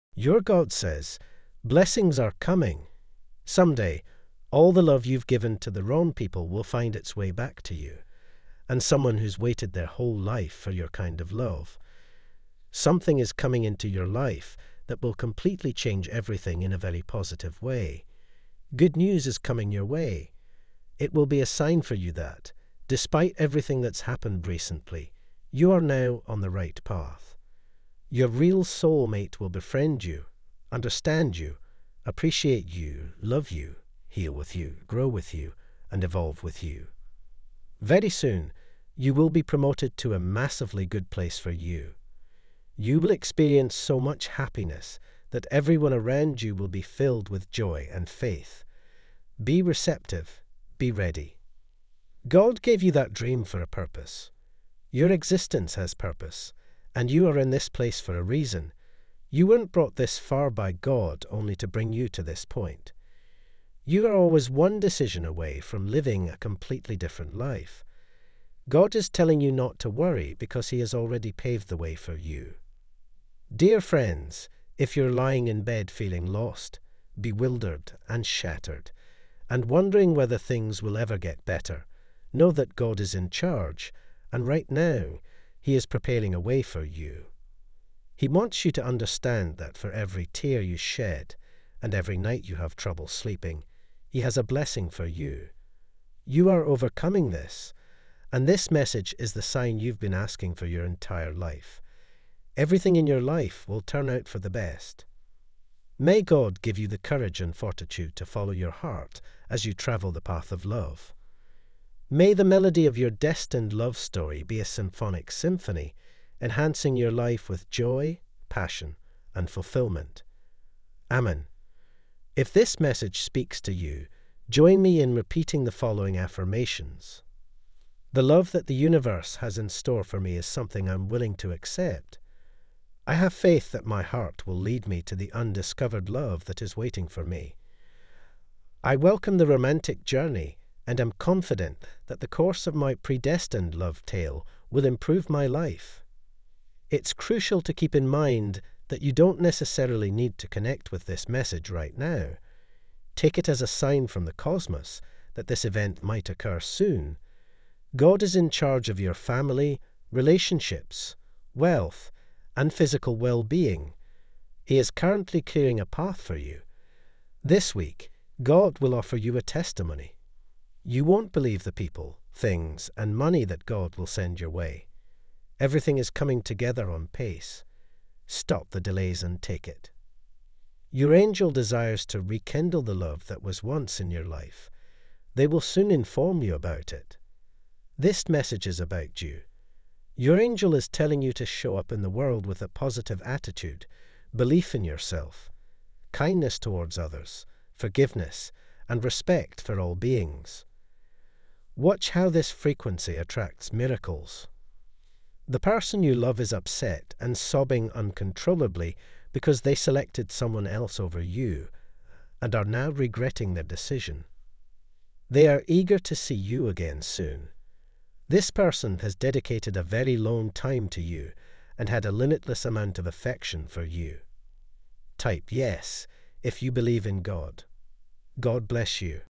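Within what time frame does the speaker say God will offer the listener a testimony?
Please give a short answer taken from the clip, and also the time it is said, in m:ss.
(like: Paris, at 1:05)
This week, at 2:47.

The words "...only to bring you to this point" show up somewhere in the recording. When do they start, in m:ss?
1:01.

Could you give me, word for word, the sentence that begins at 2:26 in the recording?
It's crucial to keep in mind that you don't necessarily need to connect with this message right now.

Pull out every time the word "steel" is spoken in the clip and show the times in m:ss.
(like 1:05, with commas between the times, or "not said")
not said.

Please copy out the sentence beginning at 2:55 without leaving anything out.
Everything is coming together on pace.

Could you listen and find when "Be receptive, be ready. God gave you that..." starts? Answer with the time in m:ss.
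0:49.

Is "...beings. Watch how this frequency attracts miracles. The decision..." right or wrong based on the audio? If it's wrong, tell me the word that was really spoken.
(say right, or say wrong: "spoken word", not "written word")
wrong: "person", not "decision".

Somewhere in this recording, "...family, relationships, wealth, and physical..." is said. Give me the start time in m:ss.
2:39.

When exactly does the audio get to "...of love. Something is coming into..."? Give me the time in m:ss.
0:11.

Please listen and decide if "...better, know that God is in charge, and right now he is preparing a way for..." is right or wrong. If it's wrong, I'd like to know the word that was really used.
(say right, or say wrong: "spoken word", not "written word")
right.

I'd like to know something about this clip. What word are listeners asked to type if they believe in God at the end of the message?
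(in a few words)
Yes.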